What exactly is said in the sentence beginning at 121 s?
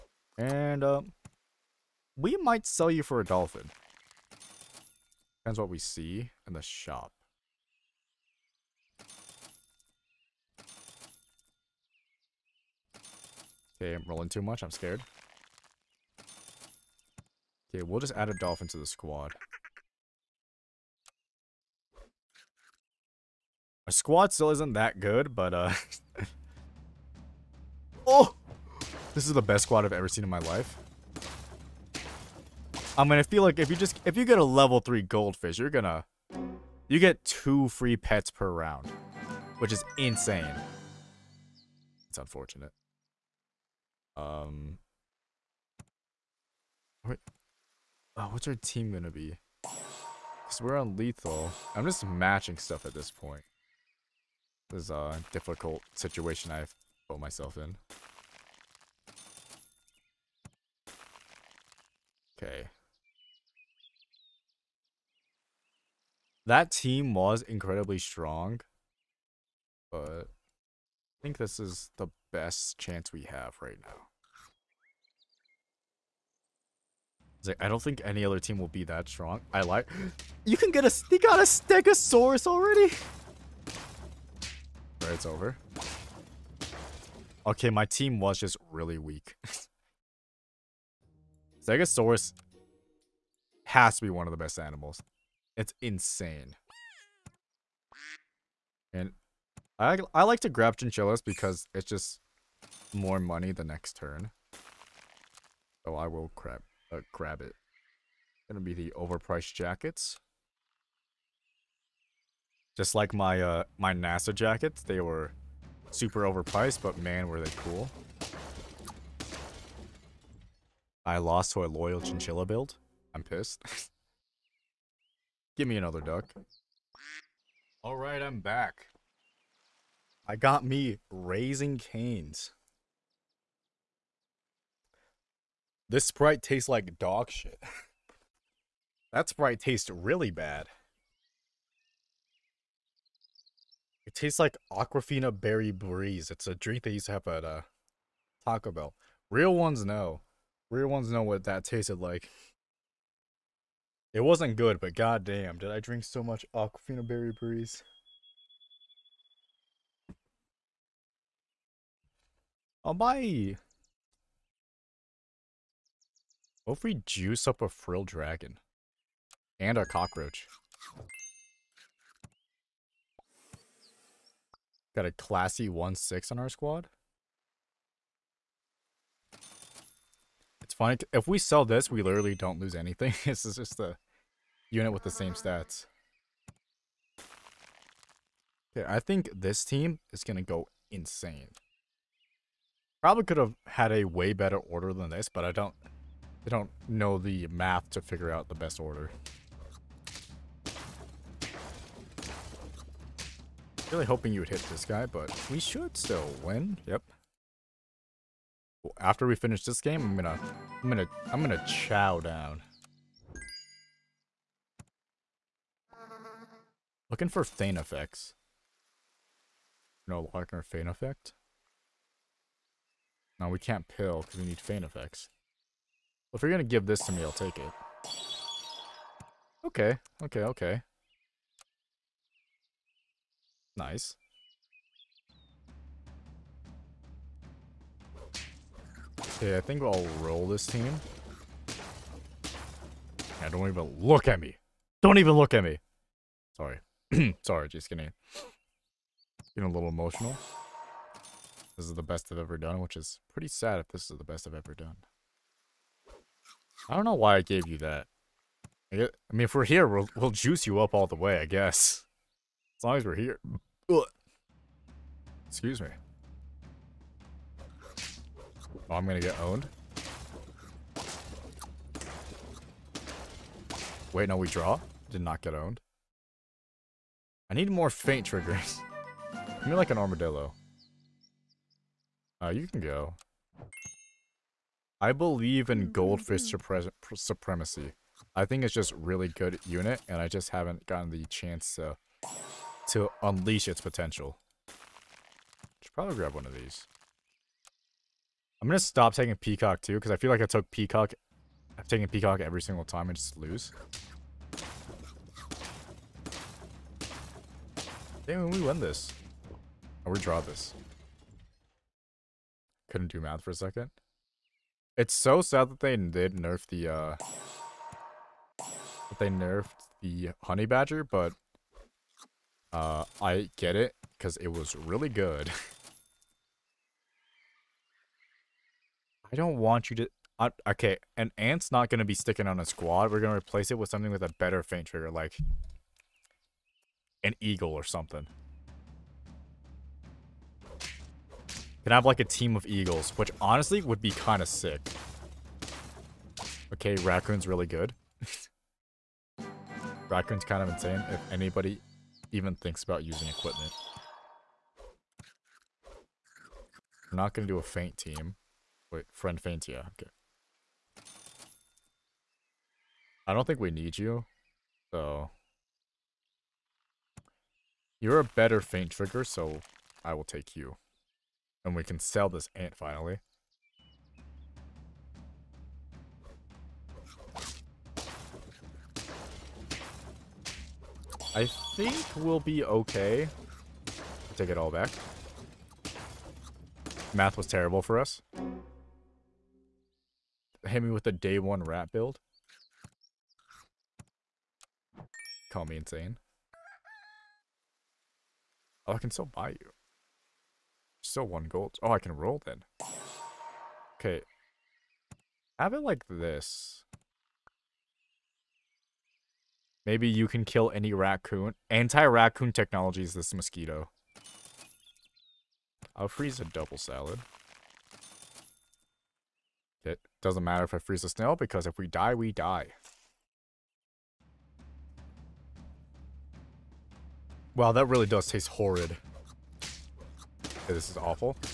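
I lost to a loyal chinchilla build.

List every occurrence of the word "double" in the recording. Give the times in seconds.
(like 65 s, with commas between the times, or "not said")
416 s.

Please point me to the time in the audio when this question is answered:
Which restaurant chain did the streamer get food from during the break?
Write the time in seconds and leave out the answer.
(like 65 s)
131 s.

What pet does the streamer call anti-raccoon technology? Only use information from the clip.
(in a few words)
mosquito.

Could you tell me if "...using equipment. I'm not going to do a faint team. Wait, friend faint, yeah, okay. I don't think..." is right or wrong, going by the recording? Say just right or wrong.
right.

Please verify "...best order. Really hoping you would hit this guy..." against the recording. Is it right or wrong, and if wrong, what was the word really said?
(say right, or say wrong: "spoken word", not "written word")
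right.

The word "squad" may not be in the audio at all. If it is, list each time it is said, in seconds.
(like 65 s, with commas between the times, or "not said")
18 s, 23 s, 29 s, 176 s, 332 s.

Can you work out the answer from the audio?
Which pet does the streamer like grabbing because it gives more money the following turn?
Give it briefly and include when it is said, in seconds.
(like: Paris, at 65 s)
chinchilla, at 100 s.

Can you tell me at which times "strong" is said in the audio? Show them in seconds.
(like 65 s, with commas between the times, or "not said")
67 s, 79 s.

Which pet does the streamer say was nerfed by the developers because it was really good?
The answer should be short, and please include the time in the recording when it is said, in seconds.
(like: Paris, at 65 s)
Honey Badger, at 320 s.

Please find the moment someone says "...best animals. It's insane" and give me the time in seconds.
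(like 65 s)
94 s.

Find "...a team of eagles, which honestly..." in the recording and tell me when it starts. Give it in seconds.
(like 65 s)
342 s.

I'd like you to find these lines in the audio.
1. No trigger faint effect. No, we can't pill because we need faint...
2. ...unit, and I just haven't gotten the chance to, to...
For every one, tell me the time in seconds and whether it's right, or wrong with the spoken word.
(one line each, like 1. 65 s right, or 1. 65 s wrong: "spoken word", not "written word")
1. 220 s wrong: "locker", not "trigger"
2. 289 s right.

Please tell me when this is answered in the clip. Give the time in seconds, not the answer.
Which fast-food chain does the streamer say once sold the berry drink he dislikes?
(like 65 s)
148 s.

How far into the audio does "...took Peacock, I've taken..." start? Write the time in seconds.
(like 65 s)
300 s.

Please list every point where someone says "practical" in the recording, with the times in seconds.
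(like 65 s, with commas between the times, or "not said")
not said.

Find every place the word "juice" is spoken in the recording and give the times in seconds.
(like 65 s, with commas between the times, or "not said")
167 s, 260 s.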